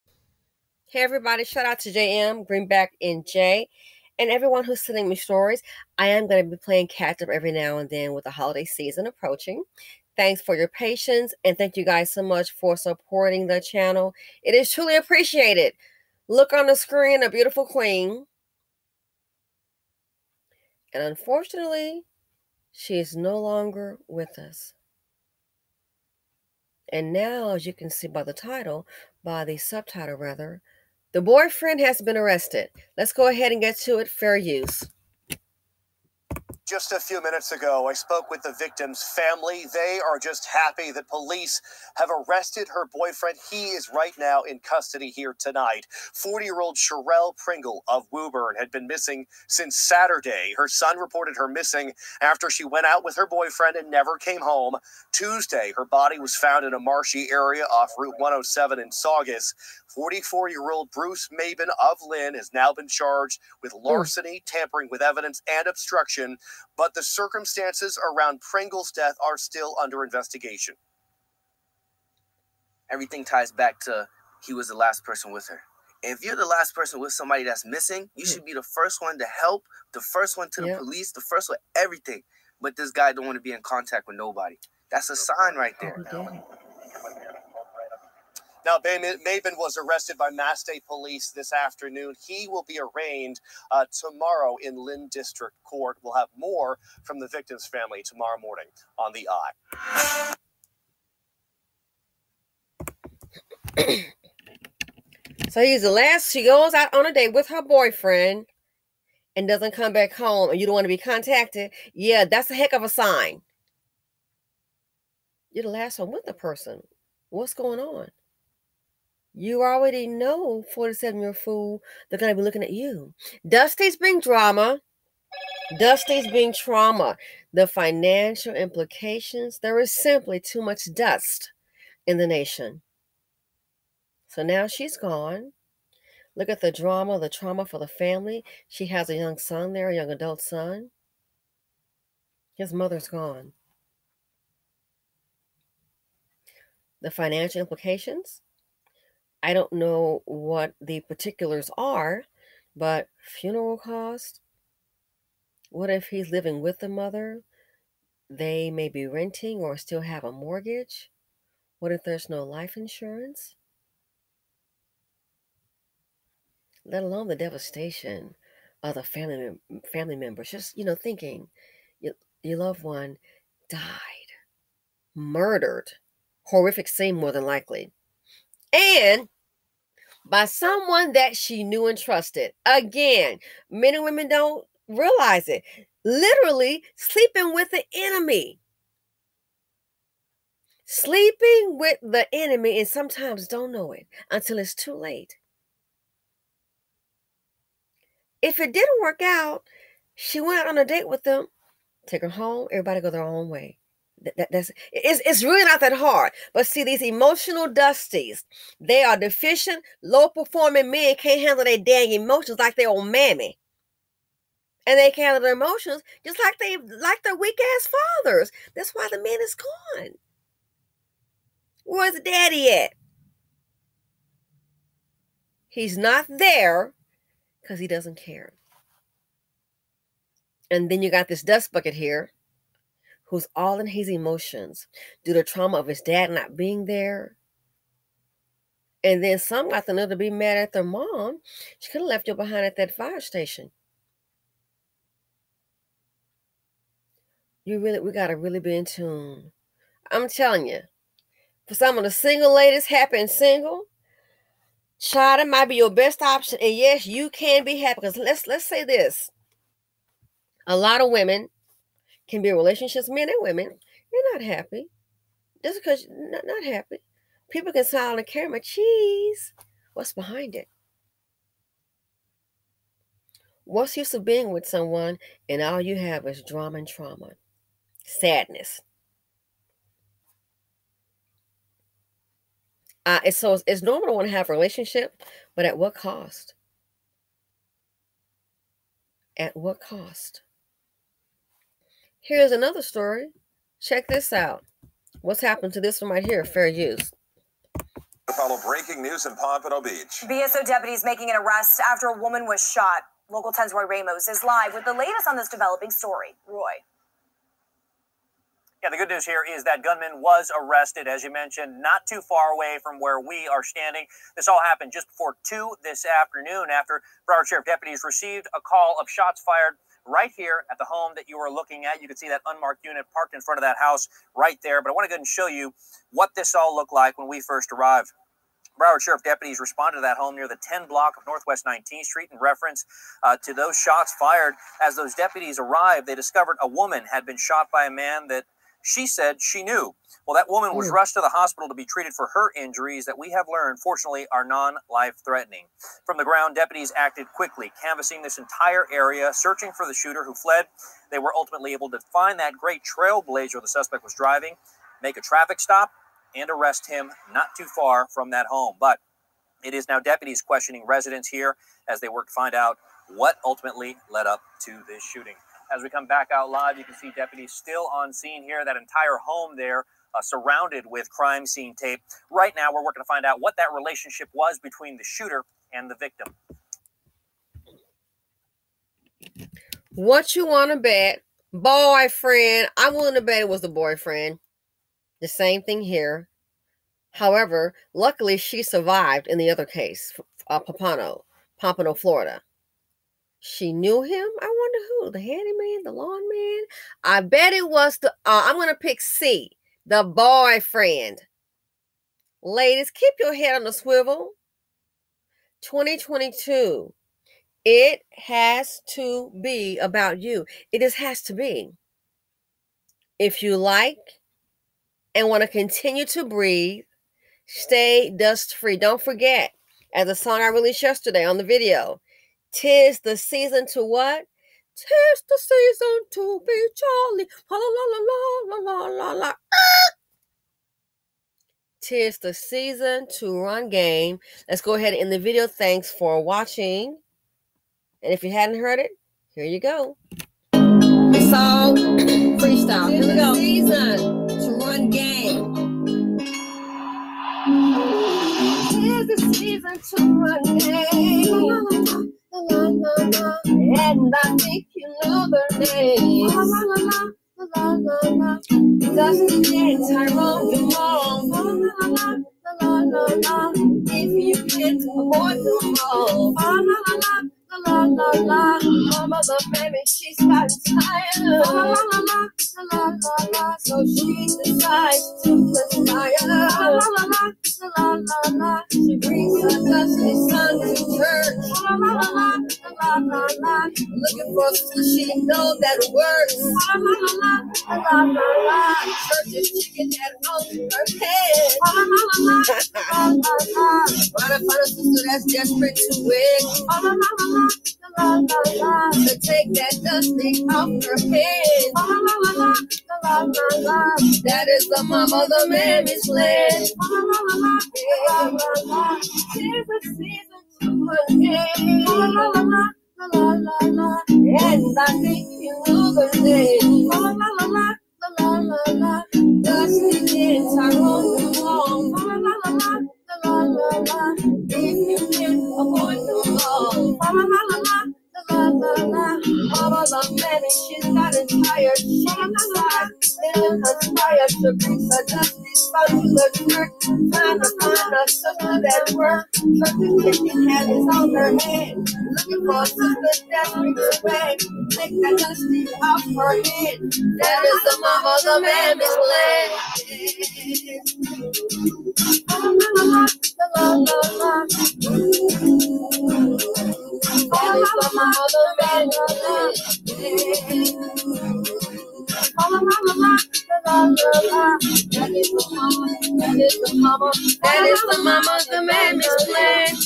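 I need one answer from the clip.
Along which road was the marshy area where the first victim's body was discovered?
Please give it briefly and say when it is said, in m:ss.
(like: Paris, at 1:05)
Route 107, at 0:57.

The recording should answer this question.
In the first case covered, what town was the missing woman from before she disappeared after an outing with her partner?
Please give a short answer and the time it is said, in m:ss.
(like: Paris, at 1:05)
Woburn, at 0:48.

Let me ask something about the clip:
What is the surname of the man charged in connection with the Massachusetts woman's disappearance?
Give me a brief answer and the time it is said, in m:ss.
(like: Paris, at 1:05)
Maben, at 1:01.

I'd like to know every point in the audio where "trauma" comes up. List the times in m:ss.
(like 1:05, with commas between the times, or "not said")
2:06, 2:17, 3:55, 4:36.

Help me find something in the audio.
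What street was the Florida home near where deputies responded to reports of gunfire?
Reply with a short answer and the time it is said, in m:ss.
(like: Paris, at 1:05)
Northwest 19th Street, at 5:31.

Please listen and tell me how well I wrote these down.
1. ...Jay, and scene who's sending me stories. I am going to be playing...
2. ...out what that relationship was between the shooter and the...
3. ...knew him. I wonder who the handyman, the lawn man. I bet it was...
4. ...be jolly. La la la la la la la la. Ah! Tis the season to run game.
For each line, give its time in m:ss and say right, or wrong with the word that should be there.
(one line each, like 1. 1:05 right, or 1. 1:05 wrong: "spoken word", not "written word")
1. 0:03 wrong: "everyone", not "scene"
2. 6:13 right
3. 6:33 right
4. 7:06 right.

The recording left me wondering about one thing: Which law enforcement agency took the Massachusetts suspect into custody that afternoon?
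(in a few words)
Mass State Police.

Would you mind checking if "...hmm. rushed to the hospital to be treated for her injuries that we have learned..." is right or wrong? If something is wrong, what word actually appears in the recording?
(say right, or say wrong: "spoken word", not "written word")
right.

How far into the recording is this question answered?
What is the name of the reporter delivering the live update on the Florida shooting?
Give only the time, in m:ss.
5:03.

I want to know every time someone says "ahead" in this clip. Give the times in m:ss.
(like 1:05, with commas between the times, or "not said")
0:33, 5:25, 7:14.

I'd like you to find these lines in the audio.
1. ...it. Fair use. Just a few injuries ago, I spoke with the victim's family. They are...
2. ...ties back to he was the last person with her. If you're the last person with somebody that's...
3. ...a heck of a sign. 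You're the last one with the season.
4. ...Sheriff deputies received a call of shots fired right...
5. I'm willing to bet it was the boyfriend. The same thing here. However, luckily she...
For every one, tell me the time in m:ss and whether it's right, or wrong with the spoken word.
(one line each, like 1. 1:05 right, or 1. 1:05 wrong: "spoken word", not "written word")
1. 0:33 wrong: "minutes", not "injuries"
2. 1:13 right
3. 1:52 wrong: "person", not "season"
4. 5:17 right
5. 6:22 right.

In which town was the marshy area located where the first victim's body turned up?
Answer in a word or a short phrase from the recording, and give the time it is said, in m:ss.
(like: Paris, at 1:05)
Saugus, at 0:58.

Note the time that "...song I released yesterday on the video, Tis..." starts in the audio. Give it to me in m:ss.
7:00.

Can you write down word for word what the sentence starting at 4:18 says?
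Because let's let's say this: a lot of women can be in relationships, men and women.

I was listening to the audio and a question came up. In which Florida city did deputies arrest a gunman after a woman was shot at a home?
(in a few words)
Pompano Beach.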